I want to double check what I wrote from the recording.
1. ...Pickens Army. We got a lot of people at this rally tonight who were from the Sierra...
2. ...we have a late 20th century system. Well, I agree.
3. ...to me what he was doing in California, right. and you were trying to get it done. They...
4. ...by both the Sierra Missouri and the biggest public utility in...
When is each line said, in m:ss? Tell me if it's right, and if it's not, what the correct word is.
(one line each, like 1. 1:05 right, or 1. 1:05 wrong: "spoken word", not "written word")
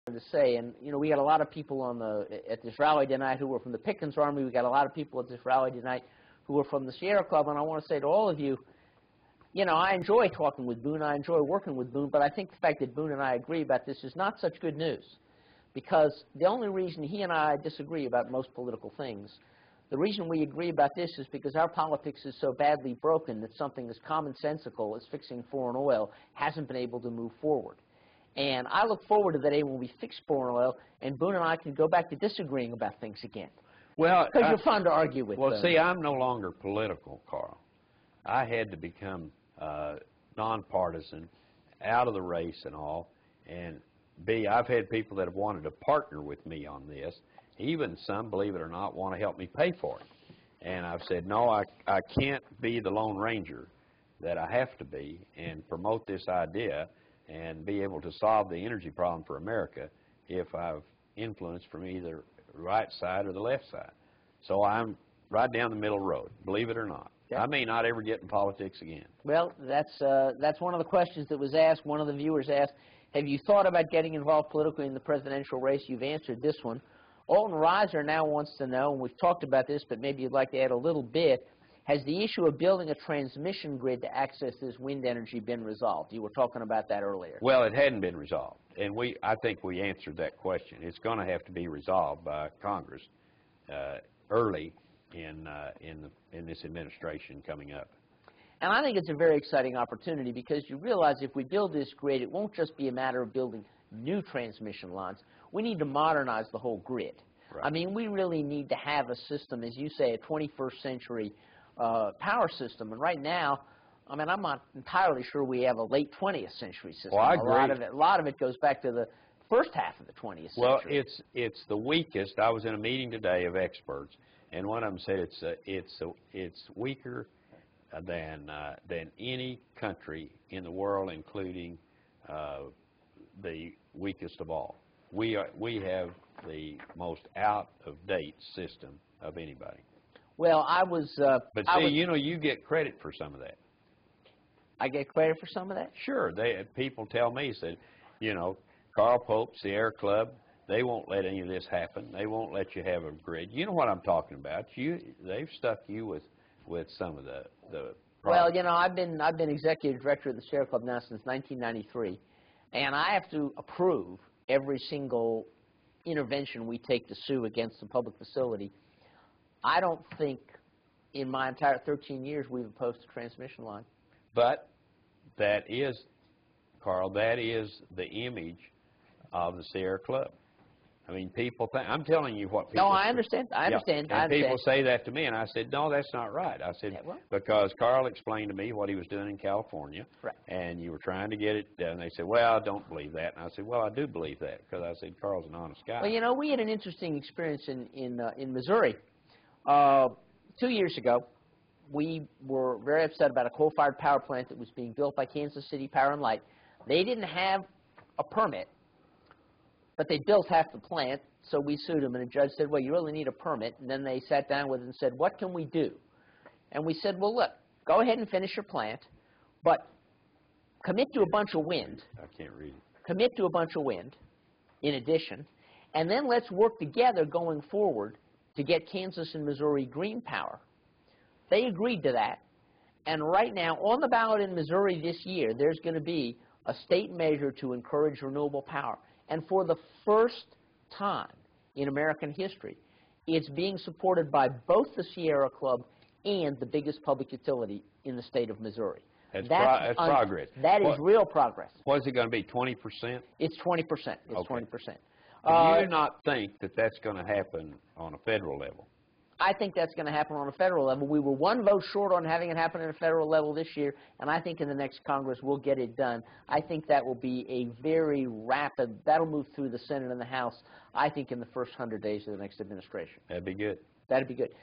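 1. 0:03 right
2. 1:55 right
3. 3:08 right
4. 4:04 wrong: "Club", not "Missouri".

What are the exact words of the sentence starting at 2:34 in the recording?
You, they've stuck you with, with some of the the.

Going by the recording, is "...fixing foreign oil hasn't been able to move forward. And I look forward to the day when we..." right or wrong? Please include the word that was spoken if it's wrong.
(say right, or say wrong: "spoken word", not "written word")
right.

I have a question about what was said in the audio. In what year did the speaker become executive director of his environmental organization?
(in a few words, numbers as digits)
1993.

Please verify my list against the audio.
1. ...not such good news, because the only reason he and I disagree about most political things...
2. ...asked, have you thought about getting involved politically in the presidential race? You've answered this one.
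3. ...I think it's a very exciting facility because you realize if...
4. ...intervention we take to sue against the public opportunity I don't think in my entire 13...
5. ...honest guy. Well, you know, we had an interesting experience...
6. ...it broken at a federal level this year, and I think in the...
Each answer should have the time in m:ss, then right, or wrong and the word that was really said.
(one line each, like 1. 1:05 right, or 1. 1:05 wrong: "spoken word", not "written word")
1. 0:14 right
2. 1:12 right
3. 1:38 wrong: "opportunity", not "facility"
4. 2:46 wrong: "facility", not "opportunity"
5. 3:15 right
6. 4:22 wrong: "happen", not "broken".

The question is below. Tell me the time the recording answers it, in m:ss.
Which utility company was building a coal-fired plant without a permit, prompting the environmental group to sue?
3:25.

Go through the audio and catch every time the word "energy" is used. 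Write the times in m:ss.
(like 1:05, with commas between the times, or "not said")
0:58, 1:25.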